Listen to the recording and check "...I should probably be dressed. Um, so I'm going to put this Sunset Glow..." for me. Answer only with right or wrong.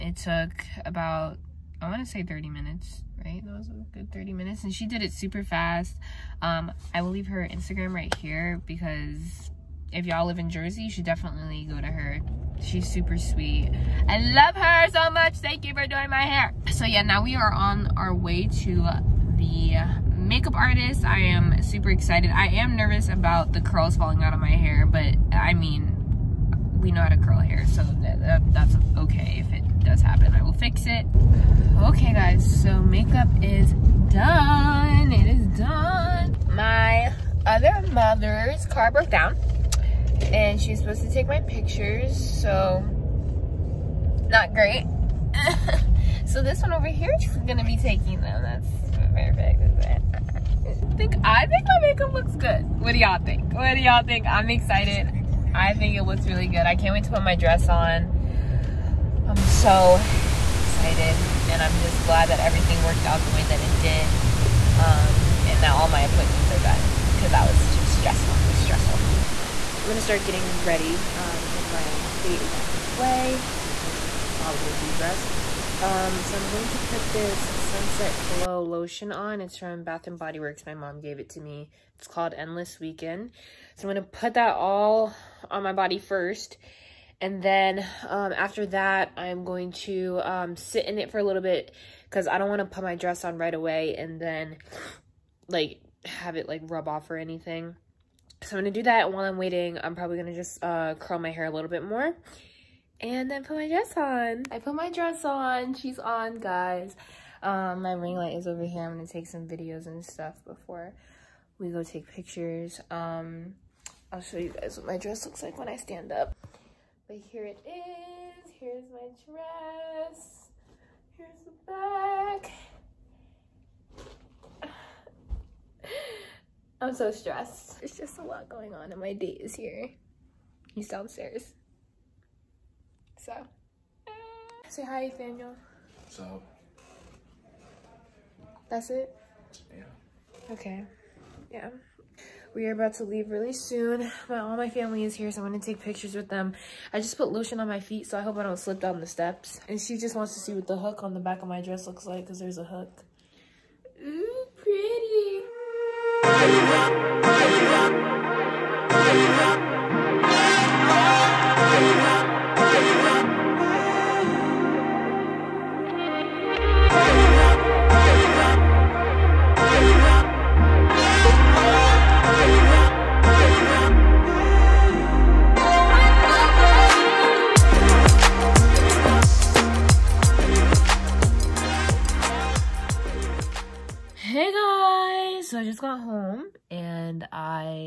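right.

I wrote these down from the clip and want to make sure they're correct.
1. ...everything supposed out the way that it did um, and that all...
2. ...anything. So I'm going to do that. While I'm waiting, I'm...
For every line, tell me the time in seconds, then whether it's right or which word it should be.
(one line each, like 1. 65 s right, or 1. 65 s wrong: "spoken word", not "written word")
1. 62 s wrong: "worked", not "supposed"
2. 97 s right.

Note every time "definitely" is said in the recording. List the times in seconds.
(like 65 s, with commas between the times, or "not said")
11 s.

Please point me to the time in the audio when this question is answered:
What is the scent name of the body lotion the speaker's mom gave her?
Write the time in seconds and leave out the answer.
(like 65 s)
82 s.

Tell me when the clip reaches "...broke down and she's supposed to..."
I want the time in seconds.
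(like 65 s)
38 s.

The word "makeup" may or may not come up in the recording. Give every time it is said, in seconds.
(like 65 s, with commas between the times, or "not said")
20 s, 32 s, 51 s.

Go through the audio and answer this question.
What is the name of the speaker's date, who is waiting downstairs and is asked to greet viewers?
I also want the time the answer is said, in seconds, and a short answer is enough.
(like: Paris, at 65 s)
Daniel, at 135 s.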